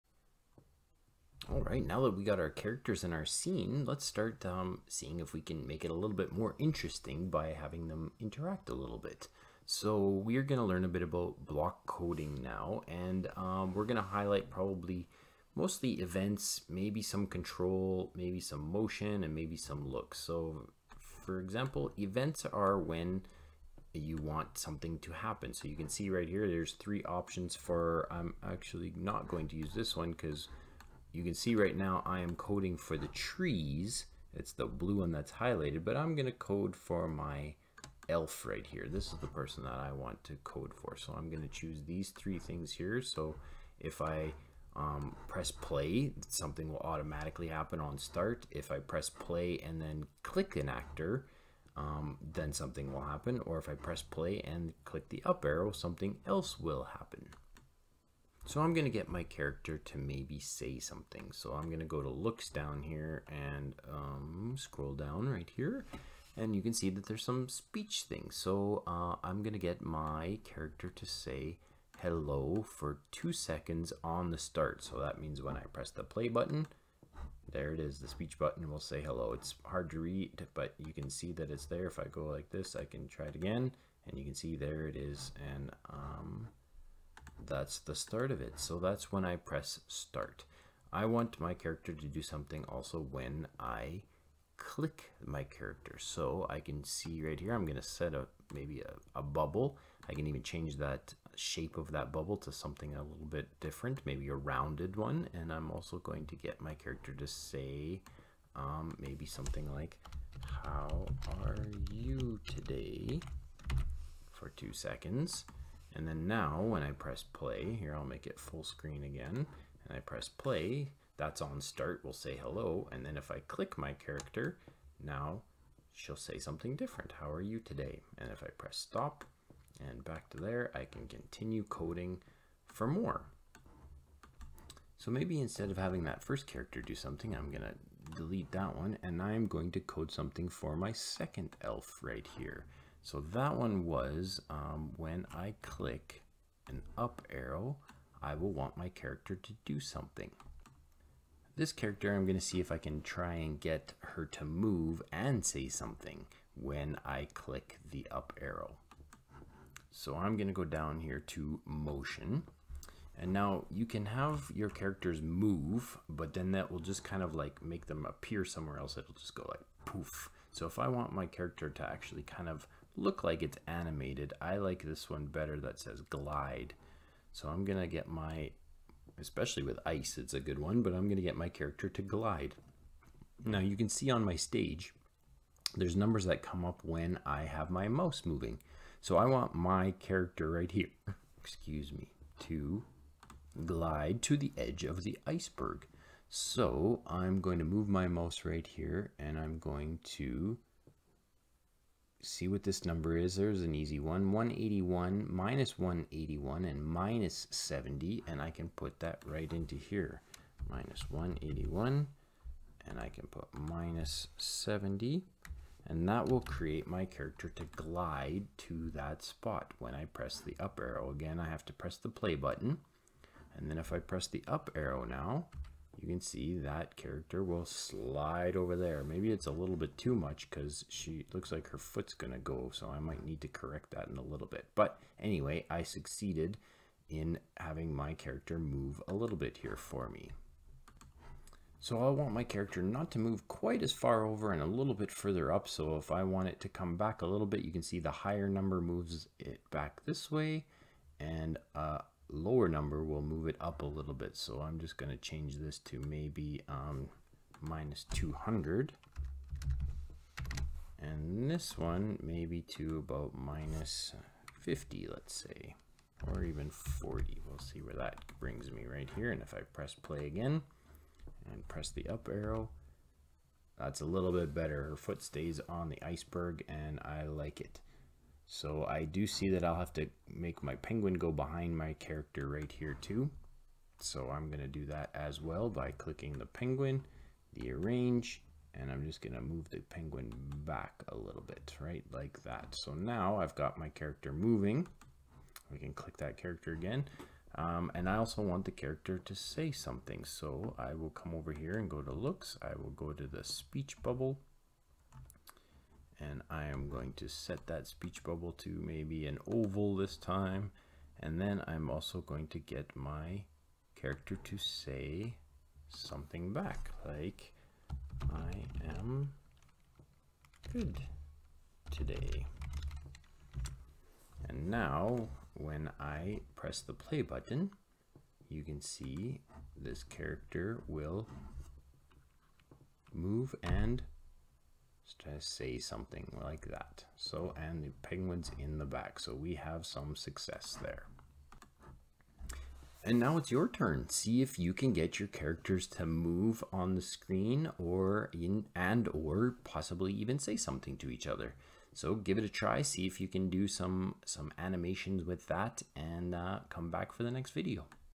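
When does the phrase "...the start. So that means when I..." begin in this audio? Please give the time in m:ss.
1:14.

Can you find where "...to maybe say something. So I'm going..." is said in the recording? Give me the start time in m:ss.
0:59.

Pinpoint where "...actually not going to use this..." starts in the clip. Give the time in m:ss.
0:28.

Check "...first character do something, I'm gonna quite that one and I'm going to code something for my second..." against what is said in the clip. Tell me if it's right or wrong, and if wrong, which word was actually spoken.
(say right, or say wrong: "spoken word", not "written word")
wrong: "delete", not "quite".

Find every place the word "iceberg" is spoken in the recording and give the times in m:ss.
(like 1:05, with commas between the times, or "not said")
3:15, 4:36.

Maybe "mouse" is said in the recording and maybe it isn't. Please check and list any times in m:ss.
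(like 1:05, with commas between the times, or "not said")
3:07, 3:18.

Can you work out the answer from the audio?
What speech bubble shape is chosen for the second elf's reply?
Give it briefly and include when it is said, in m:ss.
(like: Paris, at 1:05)
oval, at 5:09.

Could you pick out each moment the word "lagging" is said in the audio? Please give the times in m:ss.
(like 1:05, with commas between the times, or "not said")
not said.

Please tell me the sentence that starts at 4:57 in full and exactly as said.
Um, and I also want the character to say something.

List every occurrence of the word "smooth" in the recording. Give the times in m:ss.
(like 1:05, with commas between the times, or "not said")
not said.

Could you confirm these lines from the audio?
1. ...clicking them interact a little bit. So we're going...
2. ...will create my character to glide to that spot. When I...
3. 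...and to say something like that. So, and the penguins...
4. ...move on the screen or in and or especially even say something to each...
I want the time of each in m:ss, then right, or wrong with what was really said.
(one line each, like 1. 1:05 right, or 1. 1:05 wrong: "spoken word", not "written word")
1. 0:07 wrong: "having", not "clicking"
2. 3:36 right
3. 5:33 right
4. 5:46 wrong: "possibly", not "especially".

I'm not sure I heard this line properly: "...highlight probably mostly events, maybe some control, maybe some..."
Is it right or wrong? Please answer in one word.
right.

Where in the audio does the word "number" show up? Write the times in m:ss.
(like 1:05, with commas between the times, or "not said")
3:05, 3:22, 4:08, 4:12.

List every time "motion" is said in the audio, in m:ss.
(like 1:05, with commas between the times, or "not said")
0:18, 2:41.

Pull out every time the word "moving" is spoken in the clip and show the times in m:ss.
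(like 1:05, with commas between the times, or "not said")
3:08, 4:54.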